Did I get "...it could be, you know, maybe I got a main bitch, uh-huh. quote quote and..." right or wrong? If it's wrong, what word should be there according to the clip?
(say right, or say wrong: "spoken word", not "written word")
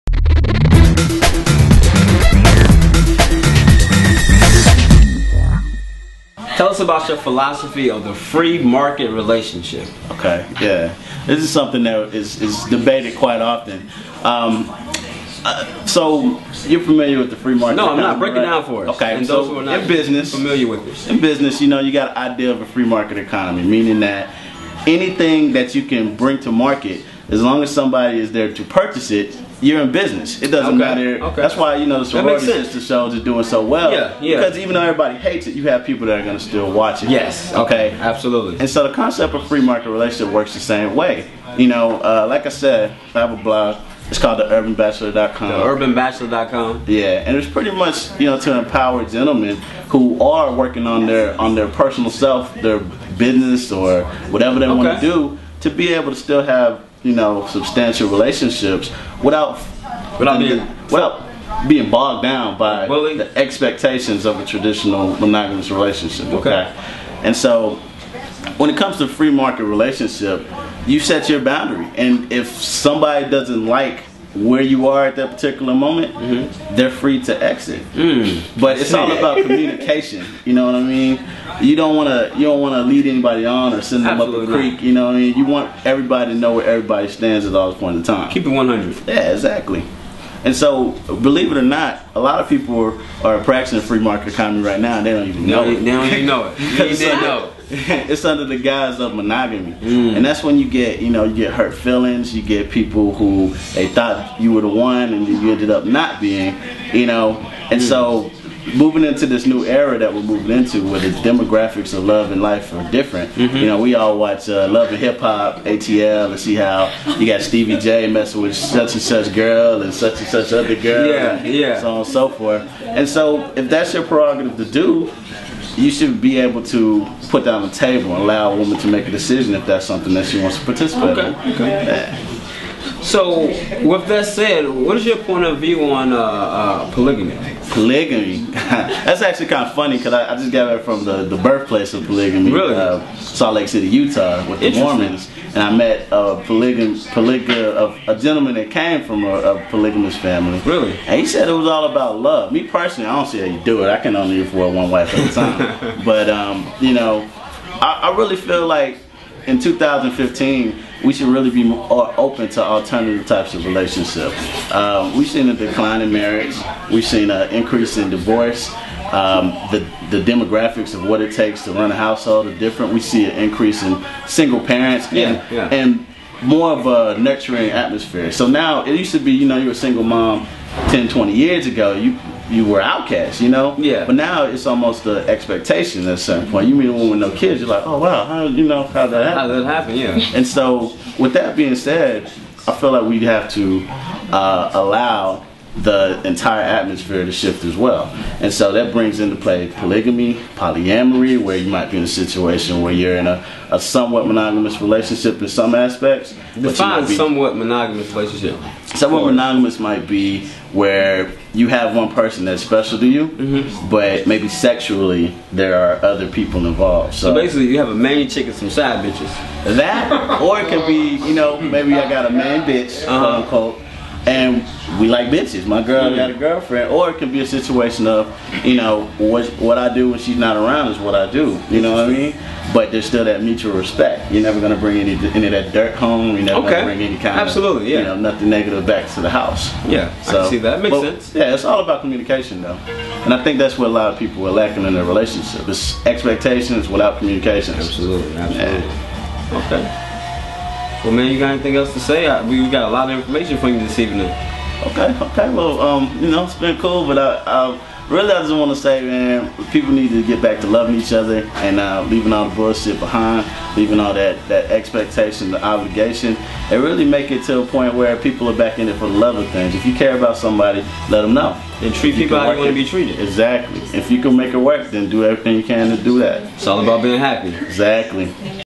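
wrong: "unquote", not "quote".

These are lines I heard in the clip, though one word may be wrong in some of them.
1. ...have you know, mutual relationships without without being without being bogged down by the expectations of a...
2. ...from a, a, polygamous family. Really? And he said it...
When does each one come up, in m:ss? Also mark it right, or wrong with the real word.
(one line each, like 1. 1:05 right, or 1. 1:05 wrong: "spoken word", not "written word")
1. 0:56 wrong: "substantial", not "mutual"
2. 2:29 right.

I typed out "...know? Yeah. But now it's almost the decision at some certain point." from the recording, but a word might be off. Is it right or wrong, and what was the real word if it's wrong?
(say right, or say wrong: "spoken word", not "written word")
wrong: "expectation", not "decision".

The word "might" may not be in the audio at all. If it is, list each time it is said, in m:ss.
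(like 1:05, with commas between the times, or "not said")
3:21, 3:29.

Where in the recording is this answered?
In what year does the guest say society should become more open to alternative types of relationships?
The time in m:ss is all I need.
2:39.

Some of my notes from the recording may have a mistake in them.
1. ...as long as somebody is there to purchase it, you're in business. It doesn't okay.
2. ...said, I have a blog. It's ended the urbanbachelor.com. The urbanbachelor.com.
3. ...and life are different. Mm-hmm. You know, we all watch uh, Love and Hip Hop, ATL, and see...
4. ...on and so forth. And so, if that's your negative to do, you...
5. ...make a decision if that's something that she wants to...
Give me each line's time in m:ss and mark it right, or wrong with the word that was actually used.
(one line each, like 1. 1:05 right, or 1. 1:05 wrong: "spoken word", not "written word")
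1. 0:27 right
2. 0:42 wrong: "called", not "ended"
3. 1:52 right
4. 2:01 wrong: "prerogative", not "negative"
5. 2:08 right.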